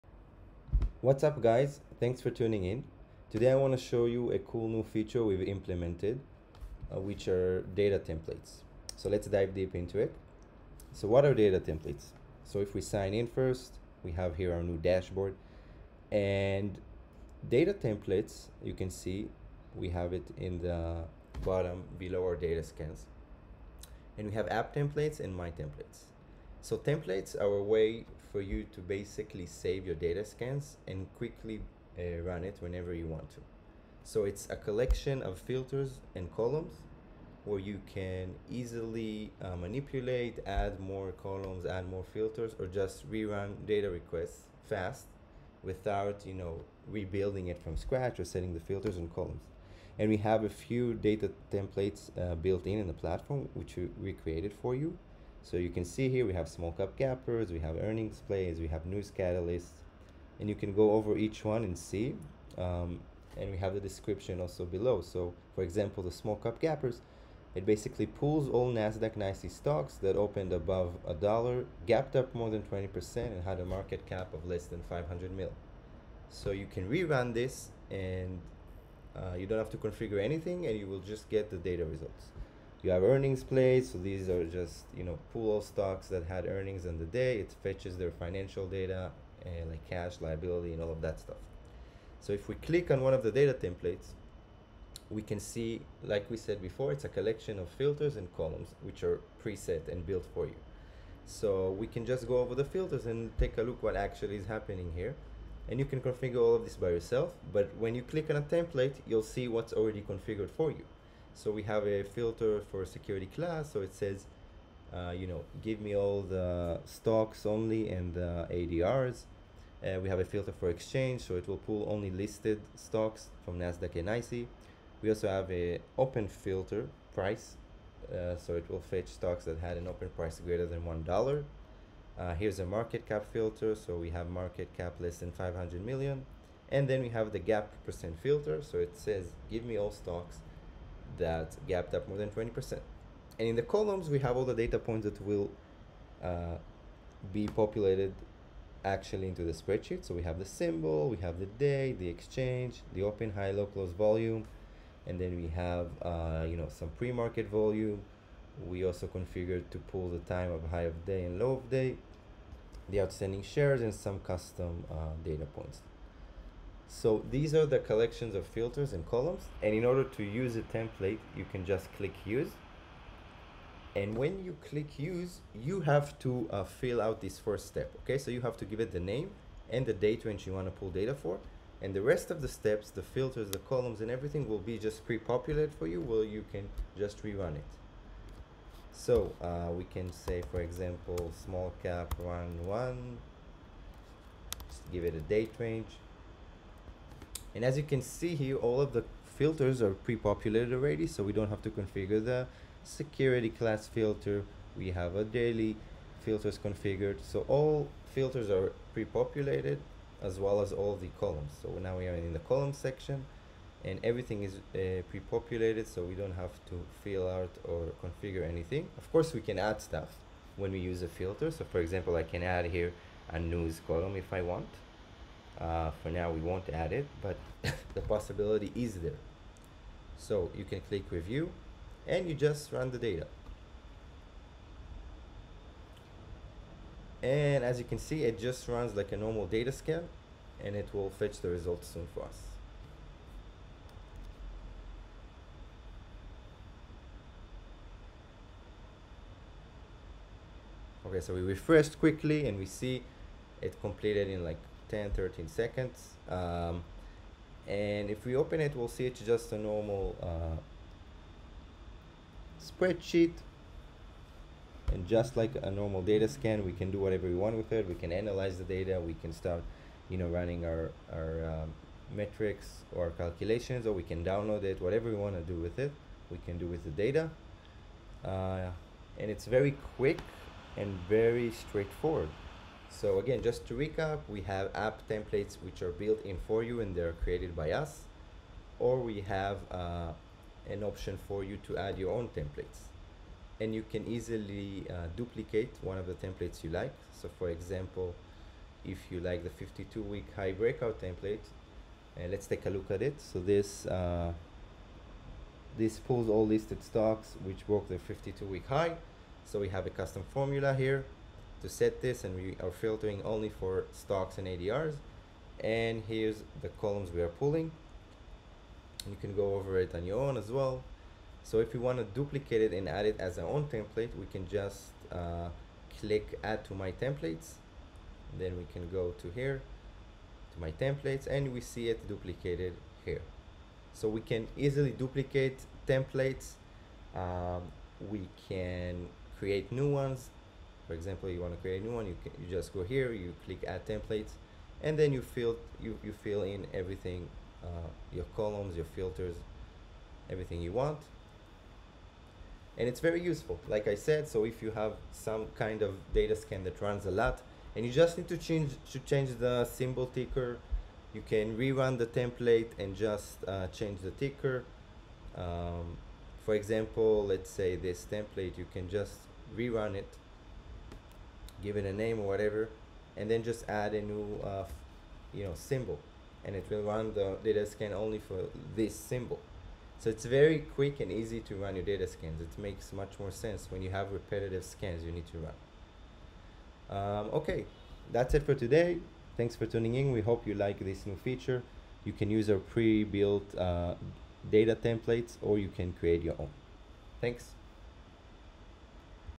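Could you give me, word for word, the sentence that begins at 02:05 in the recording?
We also have a open filter price, uh, so it will fetch stocks that had an open price greater than $1.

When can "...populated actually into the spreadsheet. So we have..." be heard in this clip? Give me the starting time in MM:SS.
02:27.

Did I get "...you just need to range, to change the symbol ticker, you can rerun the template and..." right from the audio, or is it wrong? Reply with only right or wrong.
wrong.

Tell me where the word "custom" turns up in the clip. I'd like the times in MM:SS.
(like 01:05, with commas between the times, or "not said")
02:44, 05:09.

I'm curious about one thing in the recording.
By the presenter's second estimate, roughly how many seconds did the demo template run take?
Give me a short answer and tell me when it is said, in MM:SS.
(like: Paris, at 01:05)
13 seconds, at 04:15.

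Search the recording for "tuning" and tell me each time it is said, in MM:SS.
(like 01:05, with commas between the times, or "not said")
00:02, 06:29.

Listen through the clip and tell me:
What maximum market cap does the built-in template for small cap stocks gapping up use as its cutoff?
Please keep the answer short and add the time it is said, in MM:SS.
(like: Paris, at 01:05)
500 million, at 01:14.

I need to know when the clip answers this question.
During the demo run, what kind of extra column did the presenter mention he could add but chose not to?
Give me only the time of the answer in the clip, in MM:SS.
03:43.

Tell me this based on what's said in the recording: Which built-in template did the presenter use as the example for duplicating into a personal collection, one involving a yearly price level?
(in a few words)
52 week high breakout.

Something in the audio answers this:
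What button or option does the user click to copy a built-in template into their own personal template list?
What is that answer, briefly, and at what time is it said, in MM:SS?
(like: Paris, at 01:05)
Add to my templates, at 05:26.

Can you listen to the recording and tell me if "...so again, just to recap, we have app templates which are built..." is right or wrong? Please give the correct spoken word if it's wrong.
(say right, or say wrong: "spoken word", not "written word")
right.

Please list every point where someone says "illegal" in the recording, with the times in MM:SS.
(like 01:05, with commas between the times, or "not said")
not said.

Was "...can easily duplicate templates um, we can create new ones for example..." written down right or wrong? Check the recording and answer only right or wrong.
right.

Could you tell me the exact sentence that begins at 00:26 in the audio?
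So templates are a way for you to basically save your data scans and quickly uh, run it whenever you want to.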